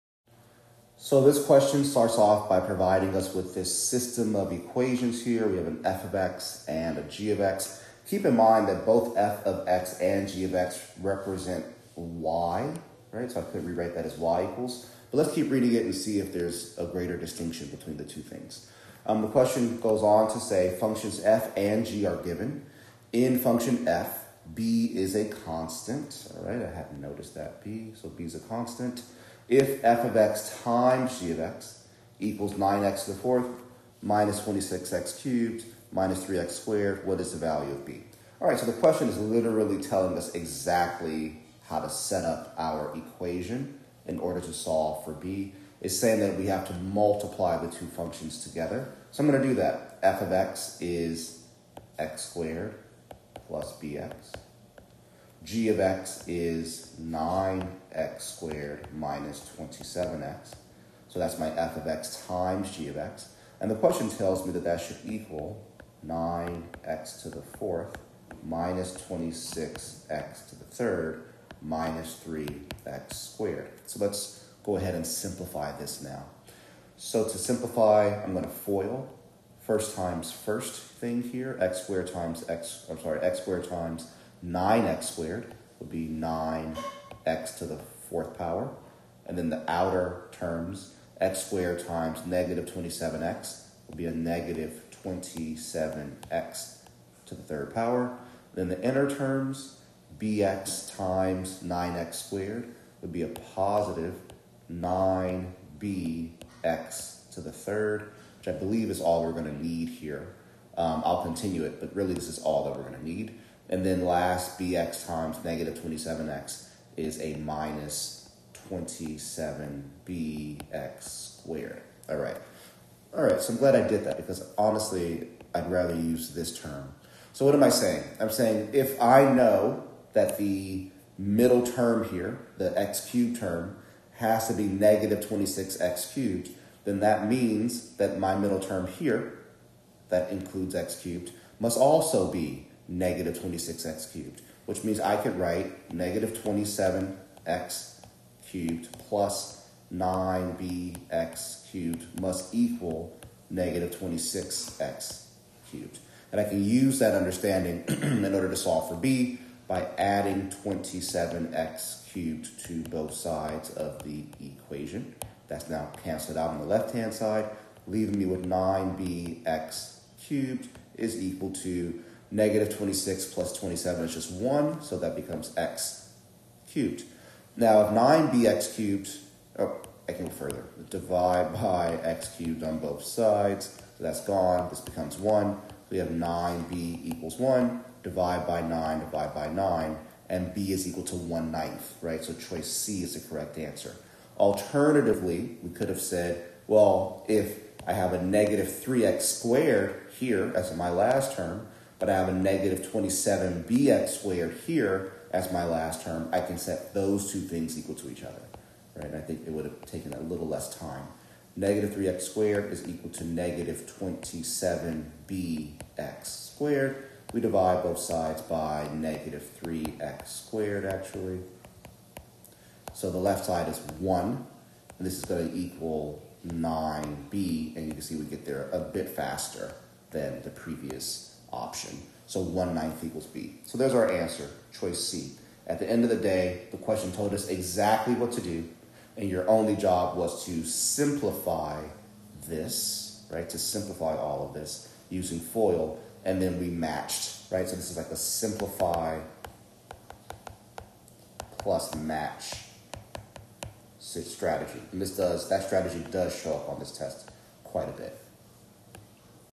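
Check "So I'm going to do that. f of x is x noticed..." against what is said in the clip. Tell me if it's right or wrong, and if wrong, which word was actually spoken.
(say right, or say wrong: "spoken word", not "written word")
wrong: "squared", not "noticed".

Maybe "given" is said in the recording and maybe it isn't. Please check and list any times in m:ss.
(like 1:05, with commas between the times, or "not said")
0:22.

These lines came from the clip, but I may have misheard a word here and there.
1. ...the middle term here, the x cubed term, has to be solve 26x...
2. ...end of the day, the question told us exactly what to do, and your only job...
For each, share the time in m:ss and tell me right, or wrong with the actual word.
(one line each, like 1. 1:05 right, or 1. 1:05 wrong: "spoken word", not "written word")
1. 2:10 wrong: "negative", not "solve"
2. 3:55 right.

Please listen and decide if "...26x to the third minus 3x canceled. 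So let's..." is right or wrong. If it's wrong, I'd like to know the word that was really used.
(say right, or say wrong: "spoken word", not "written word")
wrong: "squared", not "canceled".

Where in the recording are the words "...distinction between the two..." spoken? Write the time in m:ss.
0:17.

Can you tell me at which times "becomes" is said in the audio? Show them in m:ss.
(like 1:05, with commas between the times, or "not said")
2:55, 3:04.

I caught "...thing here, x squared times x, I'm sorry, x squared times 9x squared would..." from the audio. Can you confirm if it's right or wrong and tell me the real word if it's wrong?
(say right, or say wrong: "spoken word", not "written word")
right.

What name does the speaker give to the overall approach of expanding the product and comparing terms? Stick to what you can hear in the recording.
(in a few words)
simplify plus match.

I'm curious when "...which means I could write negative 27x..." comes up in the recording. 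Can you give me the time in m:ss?
2:24.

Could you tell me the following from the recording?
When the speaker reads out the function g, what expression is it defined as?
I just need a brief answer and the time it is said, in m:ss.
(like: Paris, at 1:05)
9x squared minus 27x, at 0:57.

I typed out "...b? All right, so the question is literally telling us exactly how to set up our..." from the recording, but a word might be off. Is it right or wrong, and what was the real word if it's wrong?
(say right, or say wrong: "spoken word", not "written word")
right.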